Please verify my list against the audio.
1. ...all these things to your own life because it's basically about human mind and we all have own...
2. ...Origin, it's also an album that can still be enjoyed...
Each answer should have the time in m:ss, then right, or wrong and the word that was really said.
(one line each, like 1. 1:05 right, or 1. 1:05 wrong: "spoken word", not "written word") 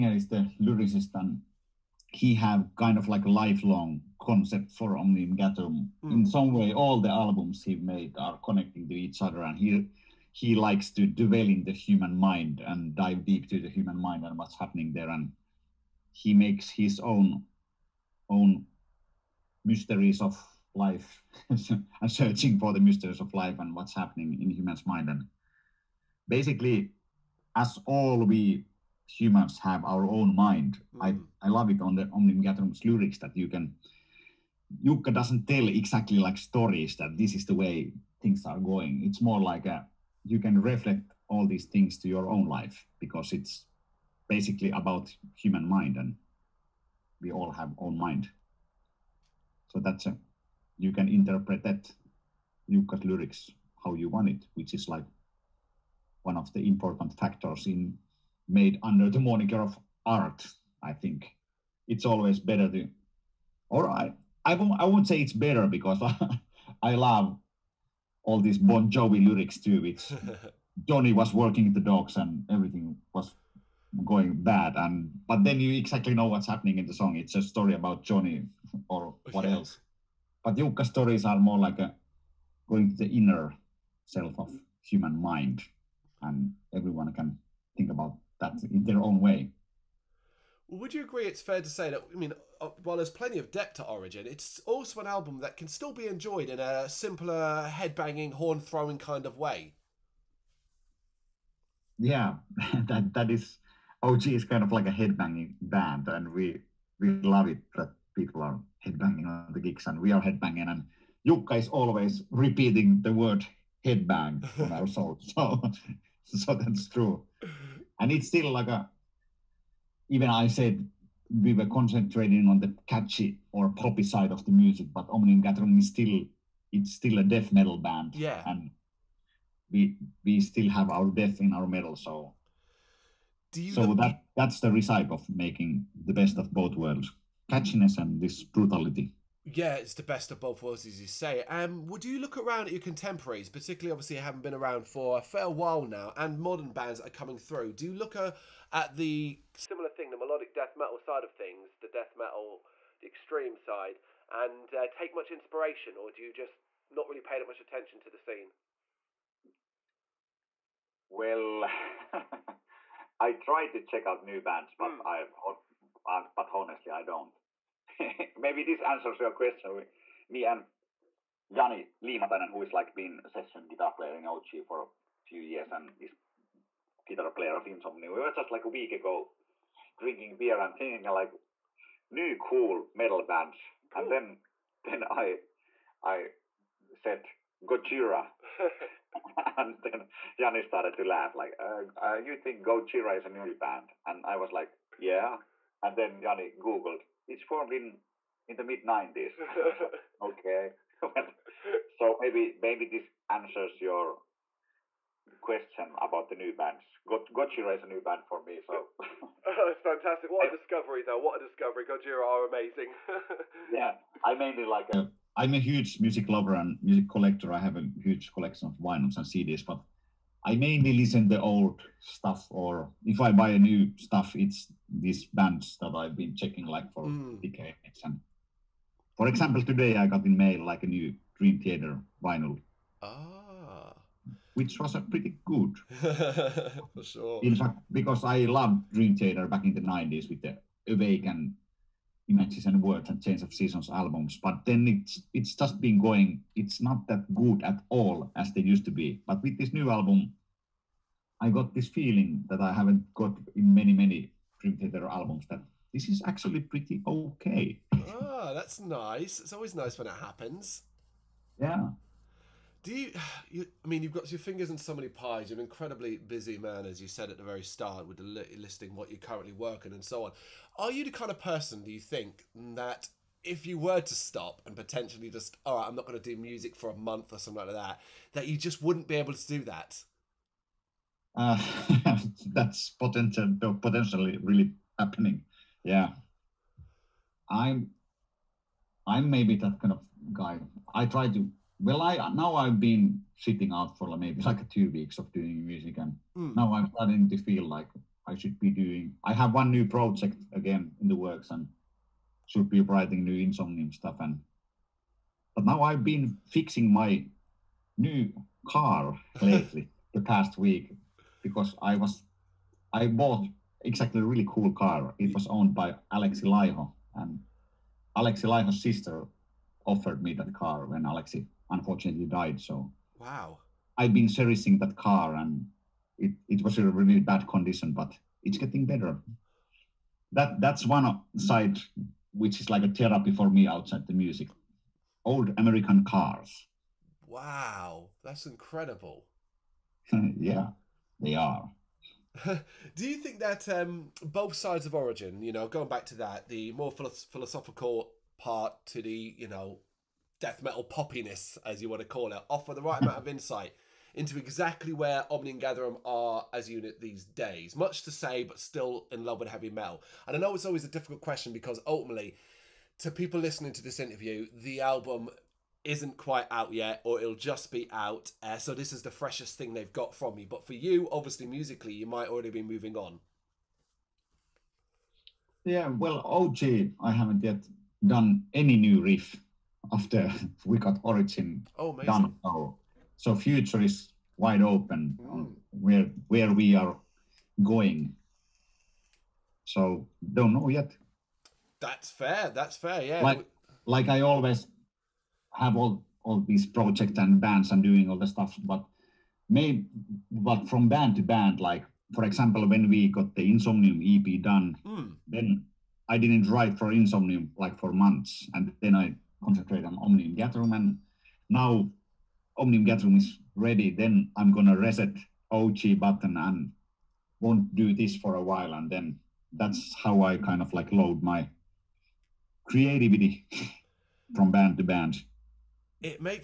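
1. 0:41 right
2. 1:33 right.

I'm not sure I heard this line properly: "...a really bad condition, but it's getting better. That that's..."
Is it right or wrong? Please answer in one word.
right.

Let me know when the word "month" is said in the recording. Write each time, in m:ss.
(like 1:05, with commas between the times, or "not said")
4:36, 6:47.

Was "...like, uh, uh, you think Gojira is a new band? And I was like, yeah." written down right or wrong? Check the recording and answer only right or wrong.
right.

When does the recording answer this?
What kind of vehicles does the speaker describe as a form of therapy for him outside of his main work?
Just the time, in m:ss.
5:35.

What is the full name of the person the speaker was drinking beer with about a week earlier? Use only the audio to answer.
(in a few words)
Jani Liimatainen.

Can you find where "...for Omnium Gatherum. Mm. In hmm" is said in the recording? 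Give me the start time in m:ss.
0:04.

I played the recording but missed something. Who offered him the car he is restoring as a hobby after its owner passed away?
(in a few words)
Alexi Laiho's sister.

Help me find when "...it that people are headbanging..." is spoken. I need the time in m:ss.
1:47.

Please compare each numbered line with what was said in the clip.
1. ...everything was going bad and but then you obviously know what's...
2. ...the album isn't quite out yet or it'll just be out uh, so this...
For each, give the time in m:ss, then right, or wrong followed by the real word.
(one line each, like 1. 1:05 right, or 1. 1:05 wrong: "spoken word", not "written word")
1. 1:12 wrong: "exactly", not "obviously"
2. 6:04 right.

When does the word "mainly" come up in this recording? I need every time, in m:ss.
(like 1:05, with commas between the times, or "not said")
3:34, 3:40.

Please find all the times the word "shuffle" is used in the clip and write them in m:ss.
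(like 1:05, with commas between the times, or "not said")
not said.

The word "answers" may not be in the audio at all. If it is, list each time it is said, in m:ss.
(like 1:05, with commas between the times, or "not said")
2:48, 3:23.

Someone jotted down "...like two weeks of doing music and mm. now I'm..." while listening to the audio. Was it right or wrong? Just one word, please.
right.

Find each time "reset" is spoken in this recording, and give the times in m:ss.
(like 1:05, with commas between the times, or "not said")
6:54.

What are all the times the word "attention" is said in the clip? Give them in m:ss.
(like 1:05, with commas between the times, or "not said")
2:37.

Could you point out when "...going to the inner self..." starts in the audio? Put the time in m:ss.
1:22.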